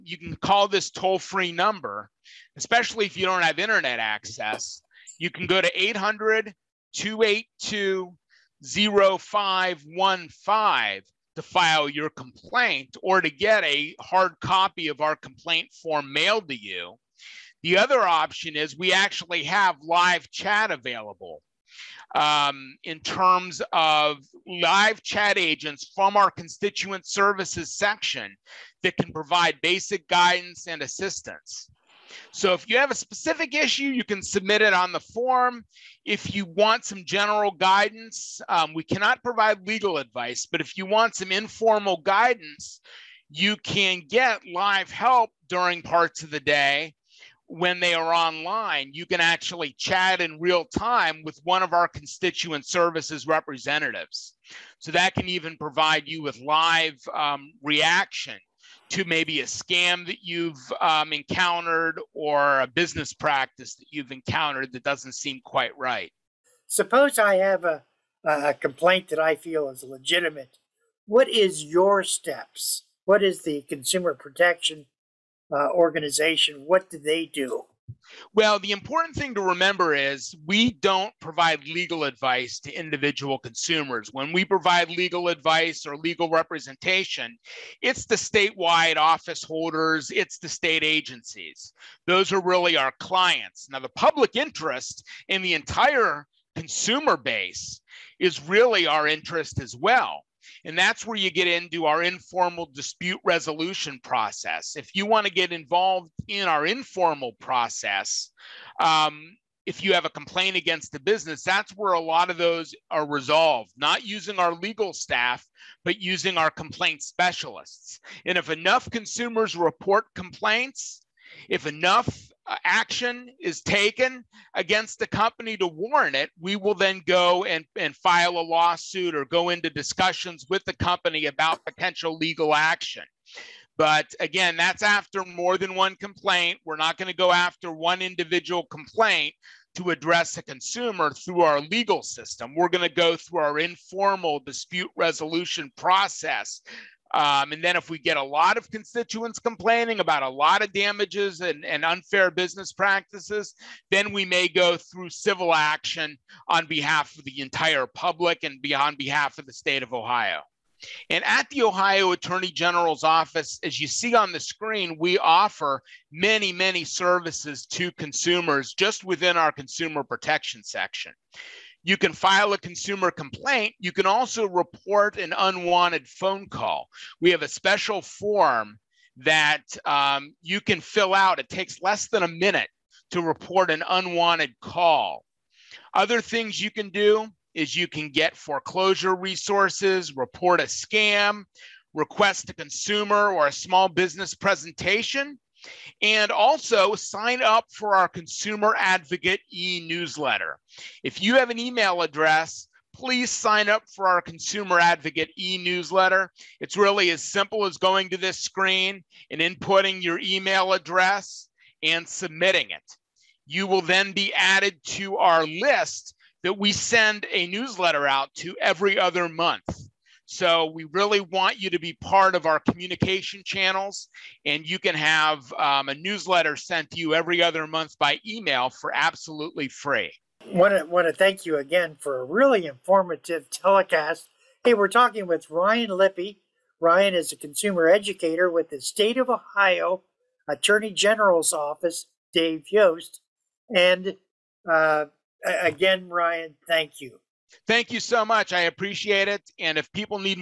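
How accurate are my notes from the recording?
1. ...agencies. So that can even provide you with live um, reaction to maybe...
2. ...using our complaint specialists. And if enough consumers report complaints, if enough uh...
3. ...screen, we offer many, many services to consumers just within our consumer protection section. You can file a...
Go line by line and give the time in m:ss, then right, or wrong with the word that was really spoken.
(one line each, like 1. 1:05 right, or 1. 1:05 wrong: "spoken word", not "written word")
1. 0:53 wrong: "representatives", not "agencies"
2. 1:56 right
3. 2:44 right.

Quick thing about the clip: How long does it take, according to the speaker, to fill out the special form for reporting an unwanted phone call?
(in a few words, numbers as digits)
less than a minute.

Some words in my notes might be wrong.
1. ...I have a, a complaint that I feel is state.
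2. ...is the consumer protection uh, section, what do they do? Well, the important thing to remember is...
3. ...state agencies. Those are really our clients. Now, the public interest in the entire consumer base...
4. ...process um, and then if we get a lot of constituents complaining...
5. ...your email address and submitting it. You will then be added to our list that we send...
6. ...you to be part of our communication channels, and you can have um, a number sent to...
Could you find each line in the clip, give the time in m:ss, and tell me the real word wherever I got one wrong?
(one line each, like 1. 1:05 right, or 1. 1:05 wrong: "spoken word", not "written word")
1. 1:07 wrong: "legitimate", not "state"
2. 1:13 wrong: "organization", not "section"
3. 1:30 right
4. 2:25 right
5. 3:30 right
6. 3:41 wrong: "newsletter", not "number".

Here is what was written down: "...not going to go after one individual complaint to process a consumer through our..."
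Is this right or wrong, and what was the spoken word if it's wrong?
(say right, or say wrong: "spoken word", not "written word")
wrong: "address", not "process".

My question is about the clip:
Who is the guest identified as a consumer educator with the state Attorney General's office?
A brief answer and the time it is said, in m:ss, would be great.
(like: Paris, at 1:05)
Ryan Lippe, at 3:55.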